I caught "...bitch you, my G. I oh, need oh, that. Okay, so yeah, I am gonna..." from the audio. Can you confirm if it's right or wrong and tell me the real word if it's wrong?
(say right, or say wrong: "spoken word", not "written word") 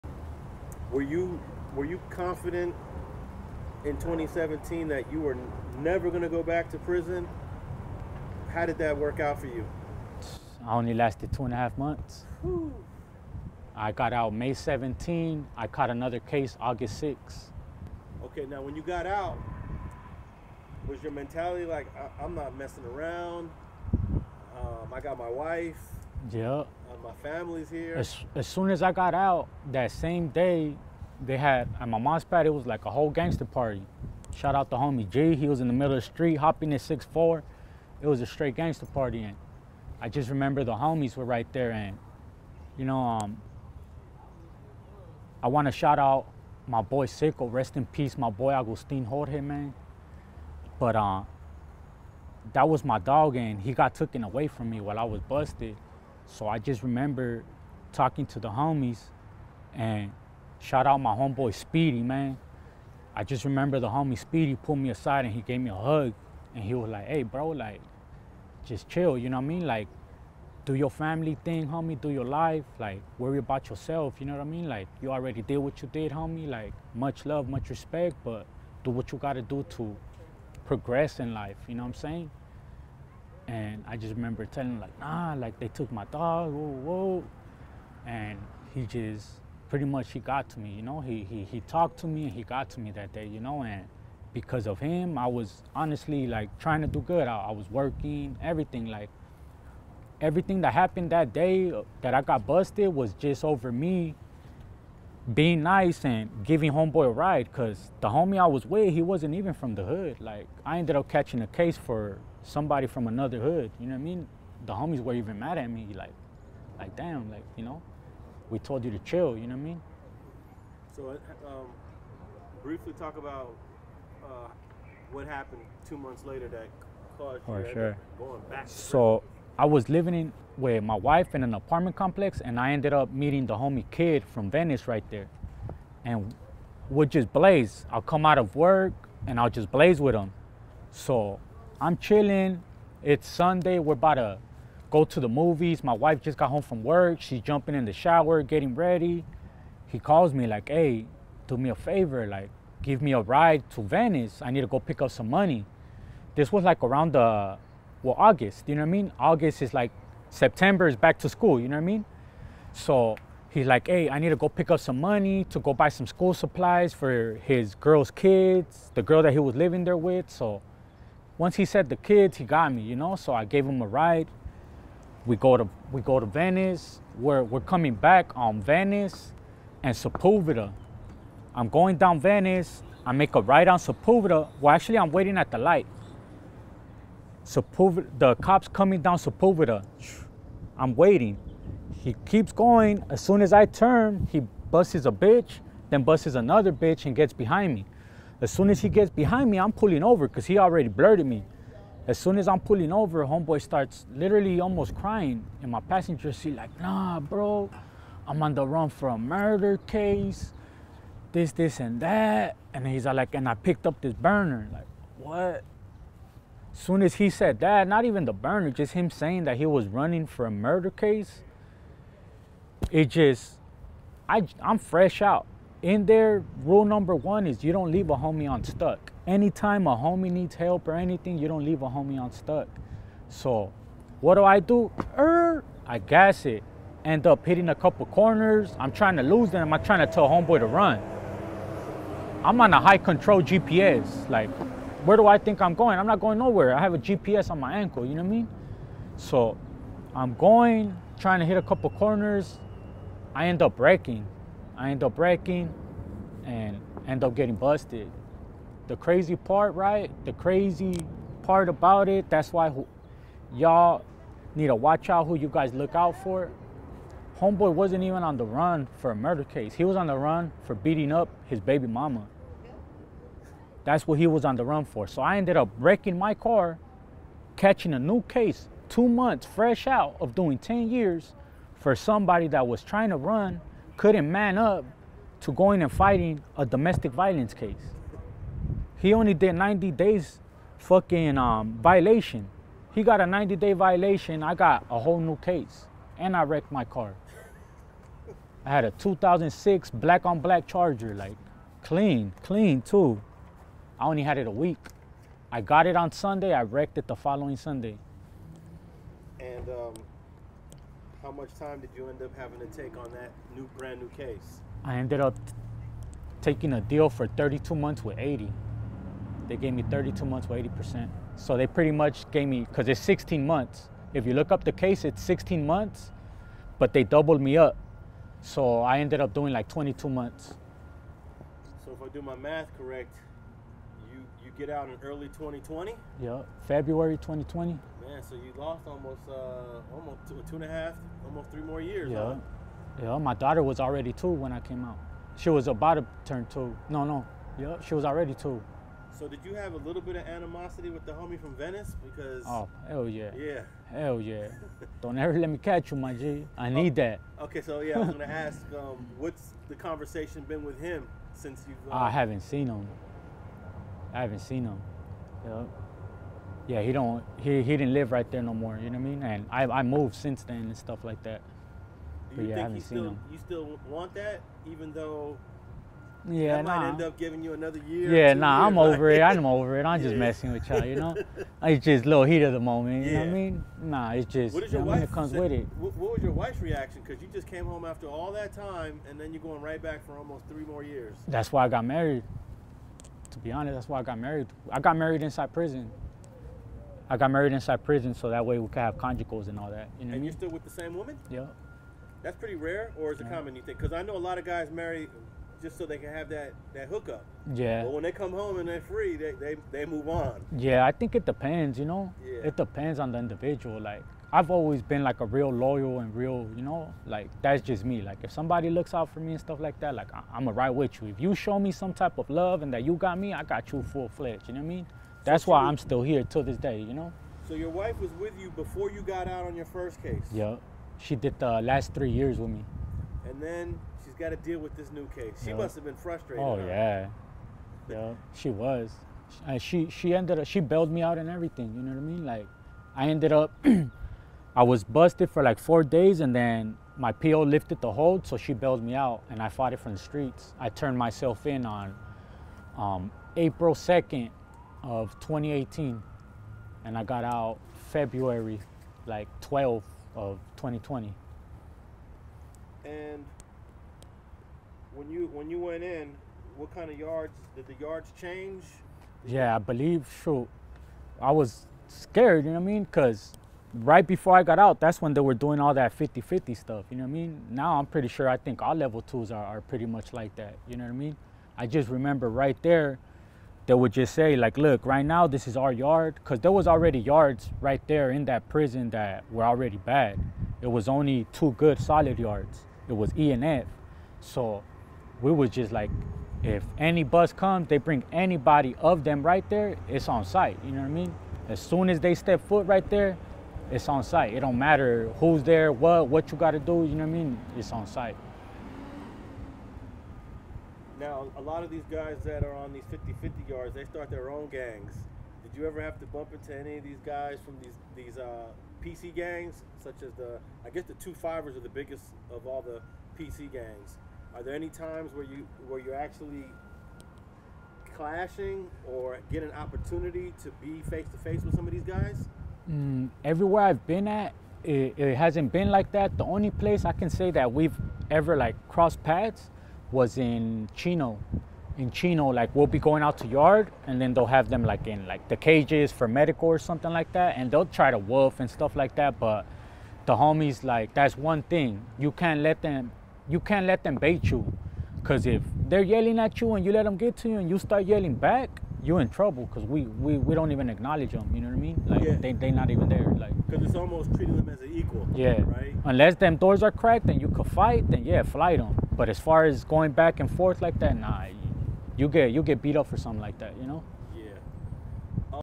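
wrong: "catch", not "bitch".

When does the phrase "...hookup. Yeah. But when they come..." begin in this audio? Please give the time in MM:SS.
06:46.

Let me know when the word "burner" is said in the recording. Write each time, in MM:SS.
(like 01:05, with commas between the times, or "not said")
03:34, 03:38.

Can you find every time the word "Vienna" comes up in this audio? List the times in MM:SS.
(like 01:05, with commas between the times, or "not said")
not said.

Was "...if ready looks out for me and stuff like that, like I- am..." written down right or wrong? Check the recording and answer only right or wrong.
wrong.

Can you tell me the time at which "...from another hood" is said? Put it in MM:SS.
01:52.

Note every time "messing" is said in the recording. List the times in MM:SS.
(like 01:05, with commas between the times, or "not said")
00:22, 06:20.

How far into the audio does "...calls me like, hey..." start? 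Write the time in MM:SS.
02:29.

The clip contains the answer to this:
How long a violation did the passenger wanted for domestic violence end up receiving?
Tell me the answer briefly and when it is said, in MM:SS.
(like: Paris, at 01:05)
90 days, at 04:53.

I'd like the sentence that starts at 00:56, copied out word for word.
So I just remember talking to the homies and shout out my homeboy Speedy, man.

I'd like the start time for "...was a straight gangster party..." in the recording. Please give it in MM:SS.
00:38.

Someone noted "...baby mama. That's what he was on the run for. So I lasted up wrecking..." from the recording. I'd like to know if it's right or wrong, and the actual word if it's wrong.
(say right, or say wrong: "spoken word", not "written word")
wrong: "ended", not "lasted".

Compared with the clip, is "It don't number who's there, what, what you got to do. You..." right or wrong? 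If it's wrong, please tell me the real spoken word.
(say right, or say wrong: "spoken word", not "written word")
wrong: "matter", not "number".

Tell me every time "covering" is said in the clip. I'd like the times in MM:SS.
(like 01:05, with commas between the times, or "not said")
not said.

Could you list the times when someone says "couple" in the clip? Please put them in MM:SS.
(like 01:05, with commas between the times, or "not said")
03:57, 04:11.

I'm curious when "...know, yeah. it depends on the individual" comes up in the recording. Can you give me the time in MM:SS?
06:51.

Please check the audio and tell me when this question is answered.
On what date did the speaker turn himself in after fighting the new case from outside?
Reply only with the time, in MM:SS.
07:33.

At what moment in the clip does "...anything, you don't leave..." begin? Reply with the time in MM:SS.
03:50.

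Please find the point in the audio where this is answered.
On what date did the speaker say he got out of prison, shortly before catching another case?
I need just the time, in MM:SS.
00:14.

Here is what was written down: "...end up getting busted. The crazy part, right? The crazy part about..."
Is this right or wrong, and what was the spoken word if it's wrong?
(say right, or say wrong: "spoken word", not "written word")
right.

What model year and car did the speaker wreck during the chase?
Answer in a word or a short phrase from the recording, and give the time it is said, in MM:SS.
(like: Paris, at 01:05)
2006 Charger, at 04:58.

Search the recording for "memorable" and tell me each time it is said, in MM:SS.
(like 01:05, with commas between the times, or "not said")
not said.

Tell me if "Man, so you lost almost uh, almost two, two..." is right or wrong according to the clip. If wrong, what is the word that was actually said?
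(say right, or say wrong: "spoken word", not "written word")
right.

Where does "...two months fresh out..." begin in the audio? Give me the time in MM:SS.
04:38.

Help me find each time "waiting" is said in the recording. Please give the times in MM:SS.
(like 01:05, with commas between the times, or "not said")
03:05, 03:10.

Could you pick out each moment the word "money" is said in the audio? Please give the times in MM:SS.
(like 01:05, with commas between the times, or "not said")
02:35, 02:44.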